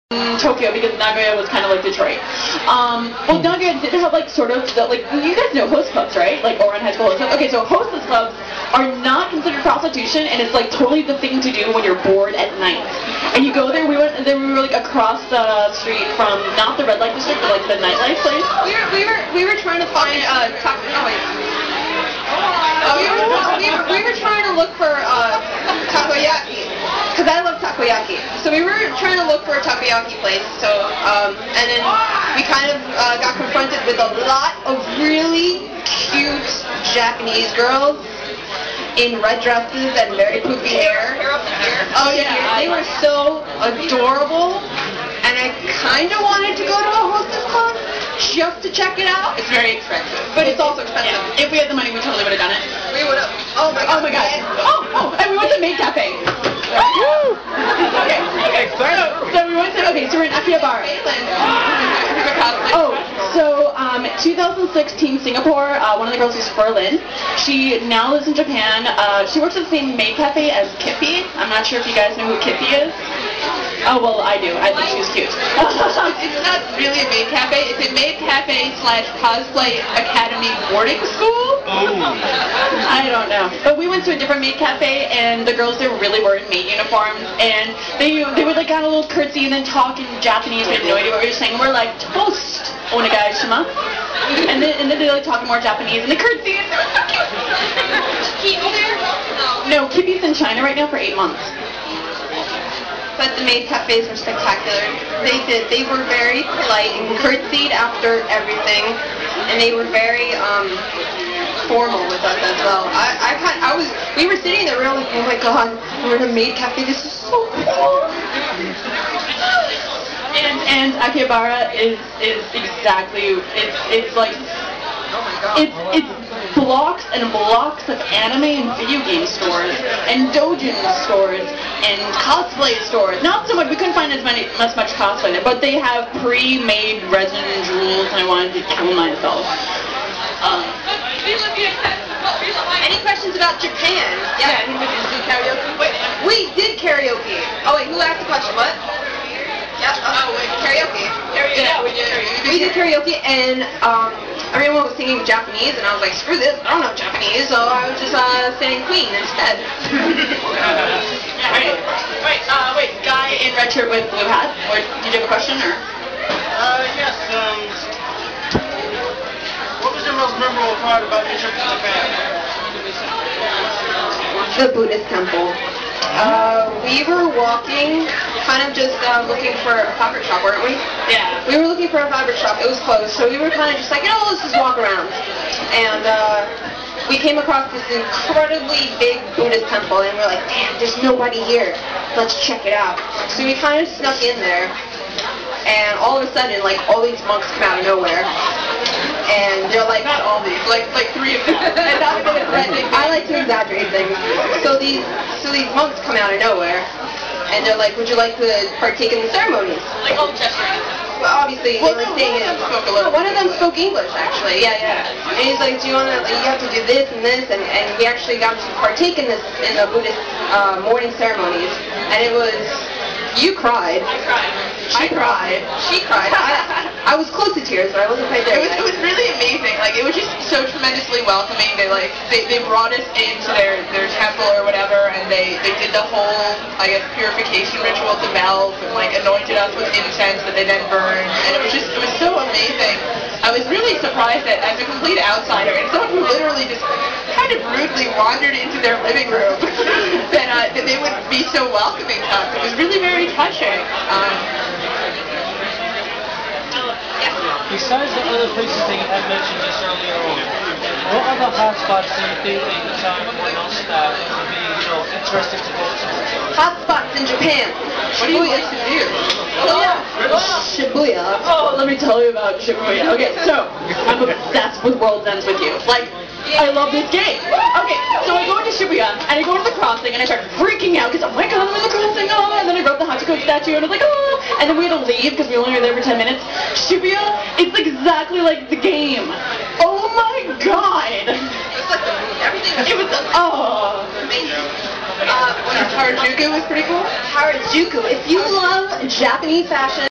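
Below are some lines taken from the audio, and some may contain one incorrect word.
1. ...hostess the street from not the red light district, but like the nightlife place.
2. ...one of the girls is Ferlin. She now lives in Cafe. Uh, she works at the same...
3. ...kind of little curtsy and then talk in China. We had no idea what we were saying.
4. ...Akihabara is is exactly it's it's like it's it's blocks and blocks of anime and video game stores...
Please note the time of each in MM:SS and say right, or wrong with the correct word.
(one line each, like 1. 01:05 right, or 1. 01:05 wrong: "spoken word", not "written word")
1. 00:14 wrong: "across", not "hostess"
2. 01:05 wrong: "Japan", not "Cafe"
3. 01:28 wrong: "Japanese", not "China"
4. 02:01 right.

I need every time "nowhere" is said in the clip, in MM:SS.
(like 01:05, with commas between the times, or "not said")
03:17, 03:26.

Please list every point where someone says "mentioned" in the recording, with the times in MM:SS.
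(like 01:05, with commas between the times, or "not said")
04:19.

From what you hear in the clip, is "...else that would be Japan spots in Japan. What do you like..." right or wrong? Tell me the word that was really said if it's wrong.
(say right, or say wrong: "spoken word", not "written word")
wrong: "Hot", not "Japan".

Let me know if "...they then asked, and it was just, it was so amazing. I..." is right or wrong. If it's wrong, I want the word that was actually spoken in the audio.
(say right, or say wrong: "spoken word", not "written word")
wrong: "burned", not "asked".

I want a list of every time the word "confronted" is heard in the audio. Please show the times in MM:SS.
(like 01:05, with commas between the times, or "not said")
00:33.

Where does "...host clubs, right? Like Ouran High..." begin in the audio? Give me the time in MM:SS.
00:05.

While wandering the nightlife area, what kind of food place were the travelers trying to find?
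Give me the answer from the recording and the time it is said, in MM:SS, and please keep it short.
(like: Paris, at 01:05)
takoyaki place, at 00:29.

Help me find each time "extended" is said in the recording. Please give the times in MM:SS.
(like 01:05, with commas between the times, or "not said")
not said.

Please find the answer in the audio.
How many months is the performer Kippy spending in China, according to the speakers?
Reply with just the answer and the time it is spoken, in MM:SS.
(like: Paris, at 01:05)
8, at 01:40.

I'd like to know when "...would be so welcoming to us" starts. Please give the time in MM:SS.
04:11.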